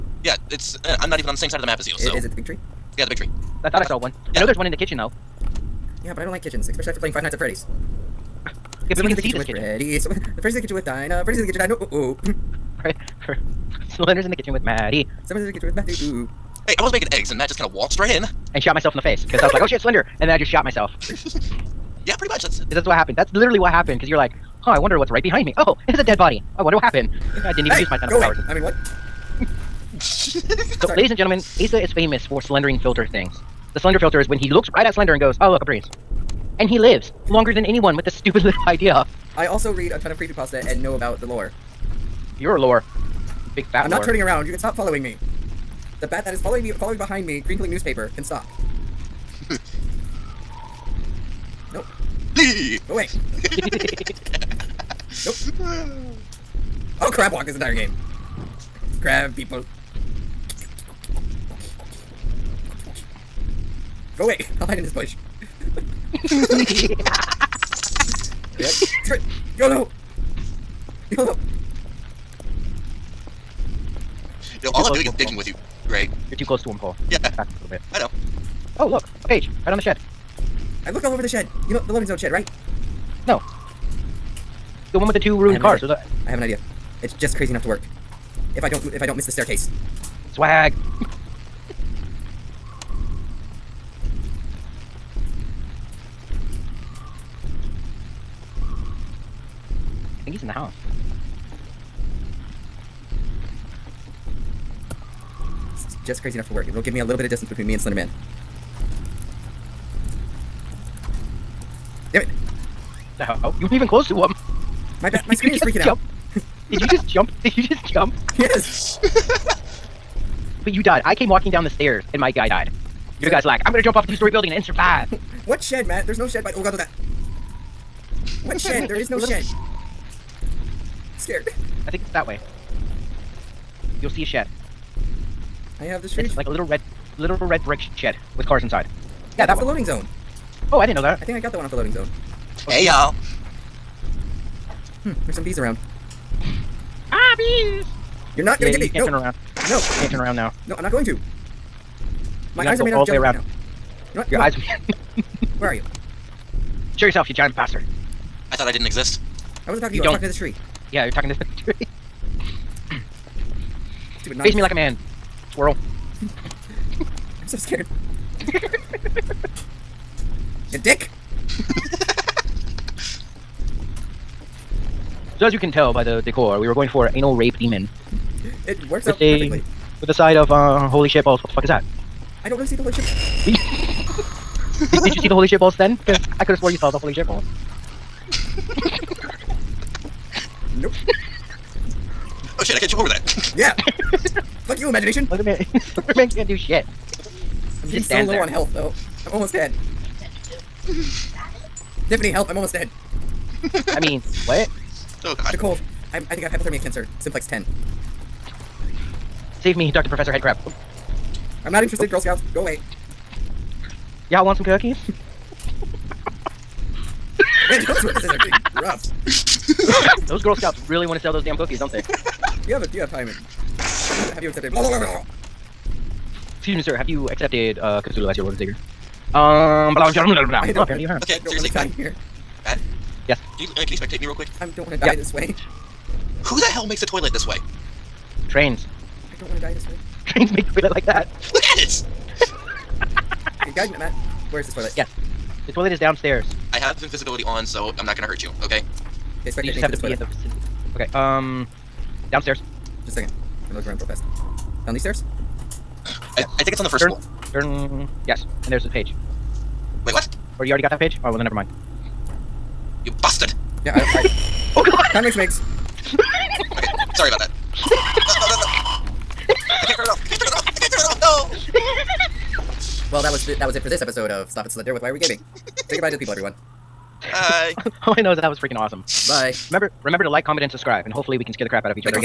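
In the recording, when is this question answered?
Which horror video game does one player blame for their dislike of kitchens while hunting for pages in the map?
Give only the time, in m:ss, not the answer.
0:07.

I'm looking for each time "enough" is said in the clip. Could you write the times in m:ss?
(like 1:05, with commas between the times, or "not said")
1:27, 1:46.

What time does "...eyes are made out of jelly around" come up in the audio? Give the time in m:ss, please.
2:32.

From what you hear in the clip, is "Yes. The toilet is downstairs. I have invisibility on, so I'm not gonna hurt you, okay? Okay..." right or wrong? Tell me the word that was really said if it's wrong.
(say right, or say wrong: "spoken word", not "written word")
right.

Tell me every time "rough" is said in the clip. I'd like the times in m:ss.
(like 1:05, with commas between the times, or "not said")
3:38.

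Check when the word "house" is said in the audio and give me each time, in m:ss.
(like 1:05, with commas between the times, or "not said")
1:40.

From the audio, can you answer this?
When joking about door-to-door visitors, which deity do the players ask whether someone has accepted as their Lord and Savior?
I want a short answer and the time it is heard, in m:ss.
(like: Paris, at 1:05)
Cthulhu, at 3:48.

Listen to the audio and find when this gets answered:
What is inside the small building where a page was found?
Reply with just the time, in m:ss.
1:25.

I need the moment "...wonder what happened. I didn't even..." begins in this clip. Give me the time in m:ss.
0:26.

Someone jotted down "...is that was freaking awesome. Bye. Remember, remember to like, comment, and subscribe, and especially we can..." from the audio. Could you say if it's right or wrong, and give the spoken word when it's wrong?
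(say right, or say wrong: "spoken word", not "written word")
wrong: "hopefully", not "especially".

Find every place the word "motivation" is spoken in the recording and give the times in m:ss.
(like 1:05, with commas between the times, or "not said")
not said.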